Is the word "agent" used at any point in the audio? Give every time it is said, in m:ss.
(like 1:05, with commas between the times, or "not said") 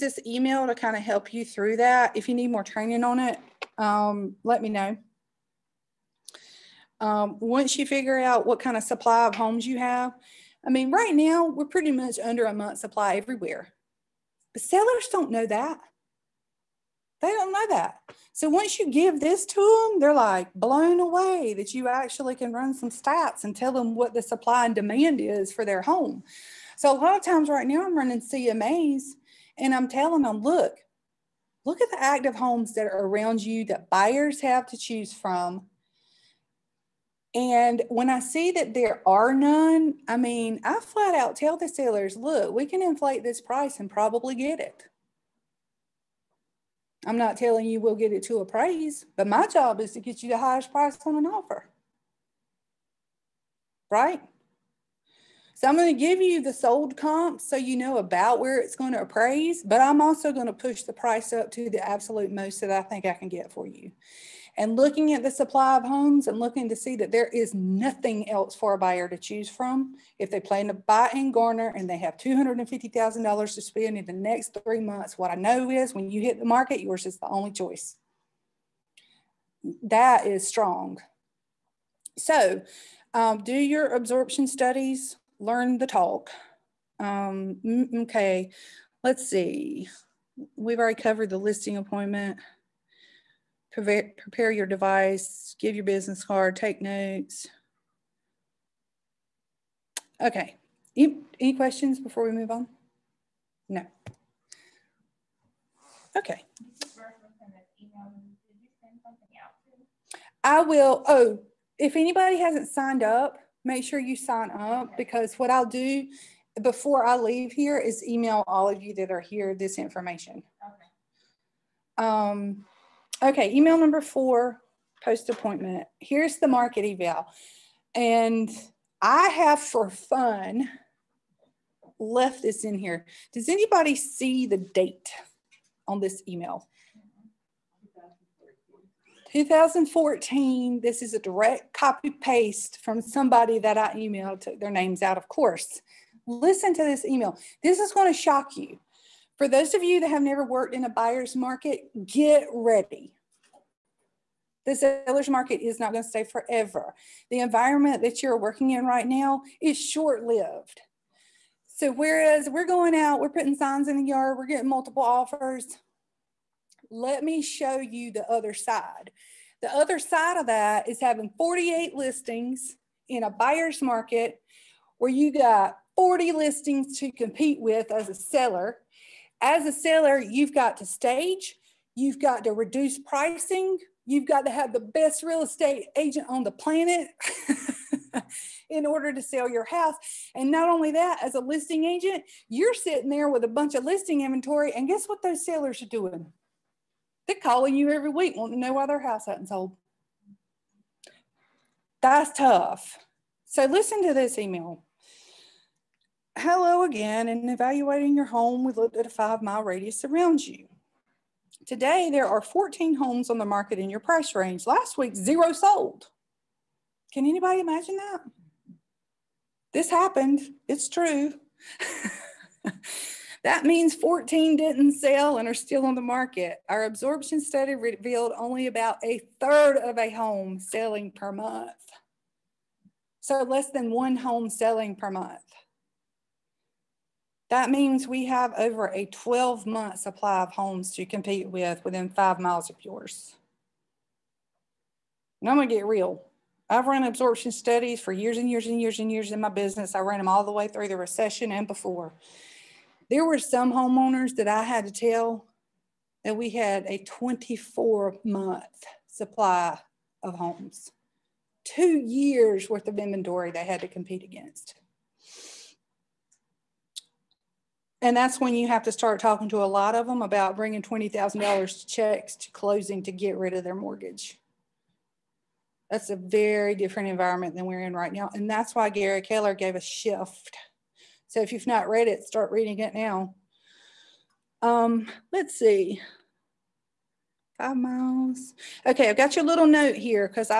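3:05, 3:11.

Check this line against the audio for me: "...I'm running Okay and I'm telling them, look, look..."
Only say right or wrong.
wrong.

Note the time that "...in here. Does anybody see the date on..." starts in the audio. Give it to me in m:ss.
2:12.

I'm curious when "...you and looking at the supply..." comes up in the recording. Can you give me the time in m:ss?
1:03.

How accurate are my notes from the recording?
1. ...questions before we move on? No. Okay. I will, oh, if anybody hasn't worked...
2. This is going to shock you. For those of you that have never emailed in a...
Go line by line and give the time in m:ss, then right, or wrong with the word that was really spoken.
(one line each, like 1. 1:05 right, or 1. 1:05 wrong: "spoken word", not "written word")
1. 1:41 wrong: "signed", not "worked"
2. 2:27 wrong: "worked", not "emailed".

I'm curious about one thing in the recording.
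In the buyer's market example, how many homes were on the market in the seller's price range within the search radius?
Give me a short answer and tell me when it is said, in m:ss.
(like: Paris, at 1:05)
14, at 3:32.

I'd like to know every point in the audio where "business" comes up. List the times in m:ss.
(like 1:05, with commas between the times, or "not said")
1:35, 4:09.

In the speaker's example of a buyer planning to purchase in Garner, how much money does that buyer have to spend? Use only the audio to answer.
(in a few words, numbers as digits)
$250,000.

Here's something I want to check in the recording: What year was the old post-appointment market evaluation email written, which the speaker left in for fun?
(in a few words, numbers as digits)
2014.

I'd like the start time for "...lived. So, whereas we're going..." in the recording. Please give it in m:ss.
2:40.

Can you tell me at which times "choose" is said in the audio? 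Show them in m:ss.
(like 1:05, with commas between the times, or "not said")
0:34, 1:09.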